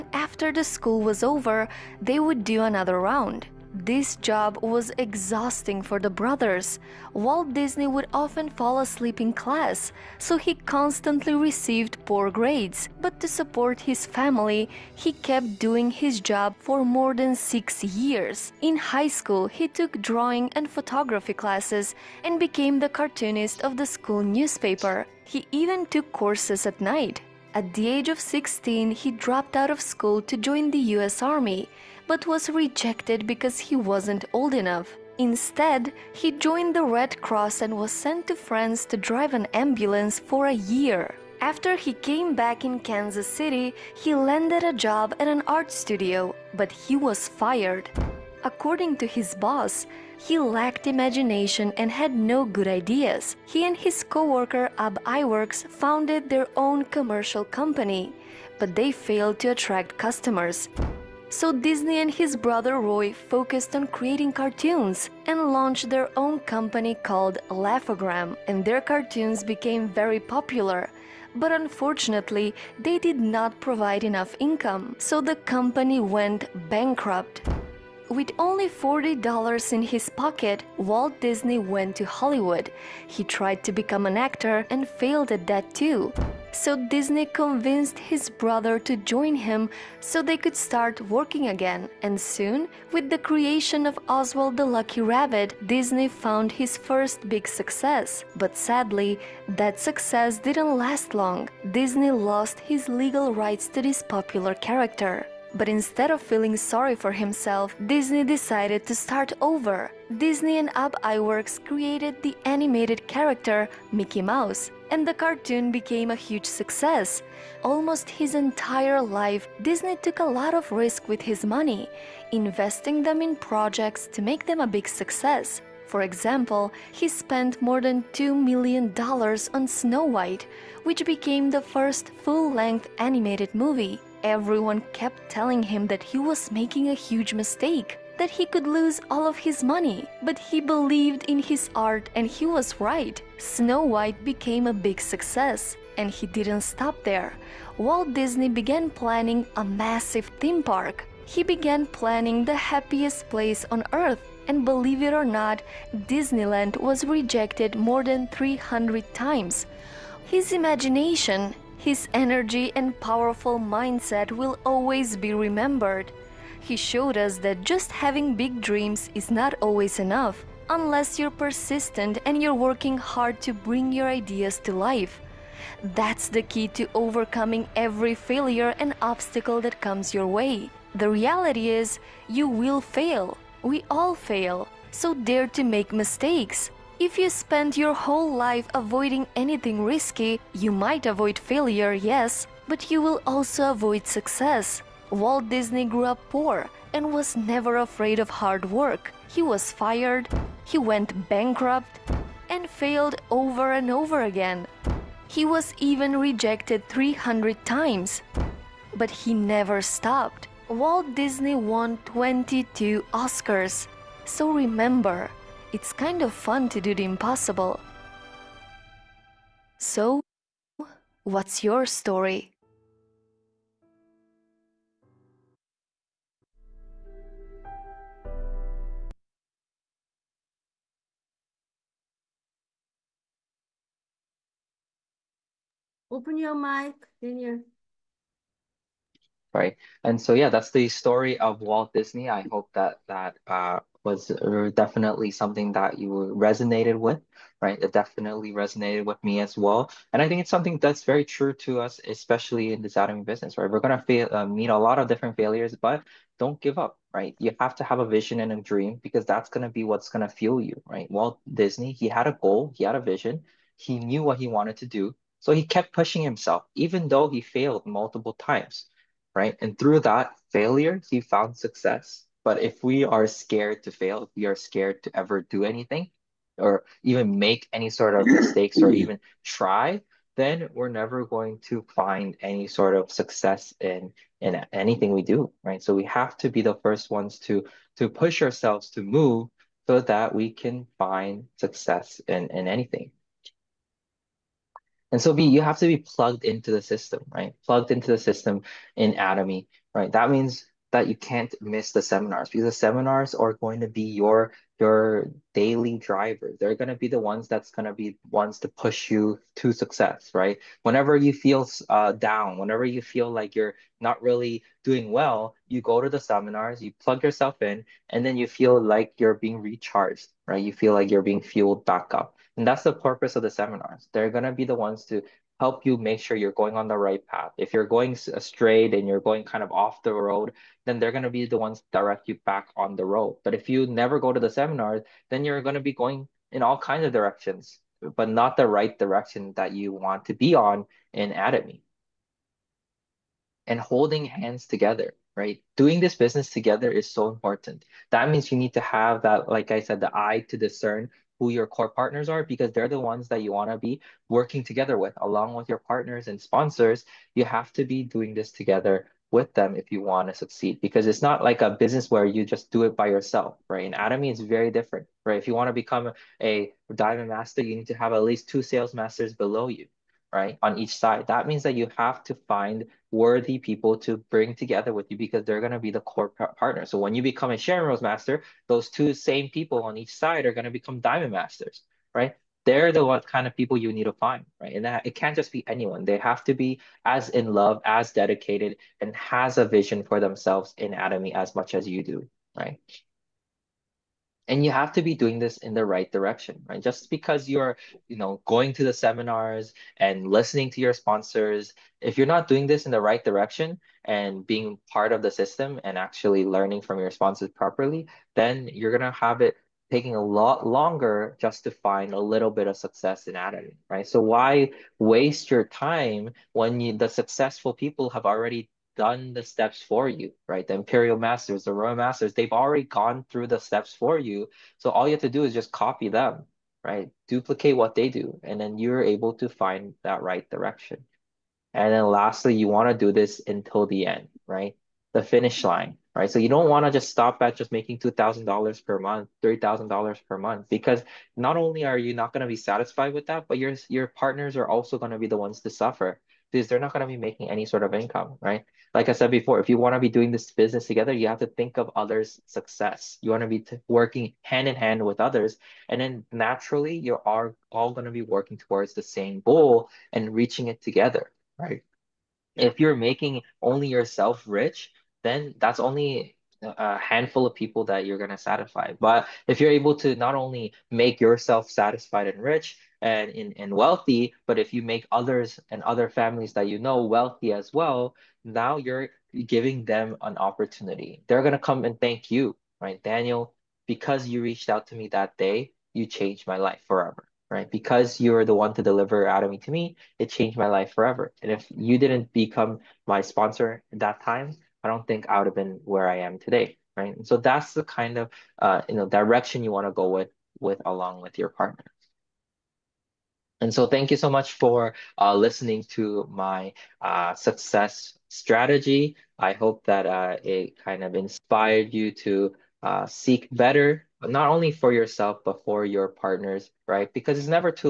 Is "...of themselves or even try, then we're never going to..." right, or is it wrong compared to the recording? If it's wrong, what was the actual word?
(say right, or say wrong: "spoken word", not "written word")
wrong: "mistakes", not "themselves".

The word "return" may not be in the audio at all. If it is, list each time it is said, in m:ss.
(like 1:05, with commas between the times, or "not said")
not said.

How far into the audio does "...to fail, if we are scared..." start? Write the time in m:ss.
4:33.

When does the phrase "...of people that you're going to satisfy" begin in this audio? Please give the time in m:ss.
7:47.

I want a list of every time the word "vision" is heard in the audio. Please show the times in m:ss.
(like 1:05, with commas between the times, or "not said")
4:18, 4:23, 6:29.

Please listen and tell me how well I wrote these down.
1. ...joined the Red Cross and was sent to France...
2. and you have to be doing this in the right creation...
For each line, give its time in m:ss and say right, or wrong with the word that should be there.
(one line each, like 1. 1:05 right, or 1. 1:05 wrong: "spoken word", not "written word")
1. 0:36 right
2. 6:34 wrong: "direction", not "creation".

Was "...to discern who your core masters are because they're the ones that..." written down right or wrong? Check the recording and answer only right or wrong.
wrong.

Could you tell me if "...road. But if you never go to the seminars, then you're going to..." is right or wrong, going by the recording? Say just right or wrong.
right.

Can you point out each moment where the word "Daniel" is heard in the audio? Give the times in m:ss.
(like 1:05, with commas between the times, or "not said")
3:57, 8:03.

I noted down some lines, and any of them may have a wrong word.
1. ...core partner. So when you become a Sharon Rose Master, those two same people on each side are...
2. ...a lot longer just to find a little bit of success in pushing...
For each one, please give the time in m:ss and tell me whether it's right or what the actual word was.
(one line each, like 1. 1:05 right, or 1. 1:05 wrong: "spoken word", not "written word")
1. 6:16 right
2. 6:50 wrong: "adding", not "pushing".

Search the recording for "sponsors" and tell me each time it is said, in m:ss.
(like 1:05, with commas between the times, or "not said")
5:56, 6:40, 6:47, 8:13.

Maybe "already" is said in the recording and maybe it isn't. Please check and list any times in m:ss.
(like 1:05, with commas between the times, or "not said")
6:58, 7:02.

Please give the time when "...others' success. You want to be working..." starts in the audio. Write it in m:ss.
7:31.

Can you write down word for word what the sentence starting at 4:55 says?
And so be you have to be plugged into the system, right?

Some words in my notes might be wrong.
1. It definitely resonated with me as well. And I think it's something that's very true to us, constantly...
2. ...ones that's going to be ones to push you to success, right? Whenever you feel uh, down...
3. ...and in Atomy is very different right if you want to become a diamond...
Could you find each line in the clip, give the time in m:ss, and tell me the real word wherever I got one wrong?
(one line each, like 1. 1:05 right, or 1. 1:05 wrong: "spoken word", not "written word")
1. 4:07 wrong: "especially", not "constantly"
2. 5:07 right
3. 6:03 right.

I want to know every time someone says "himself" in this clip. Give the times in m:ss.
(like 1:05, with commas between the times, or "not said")
1:47, 4:26.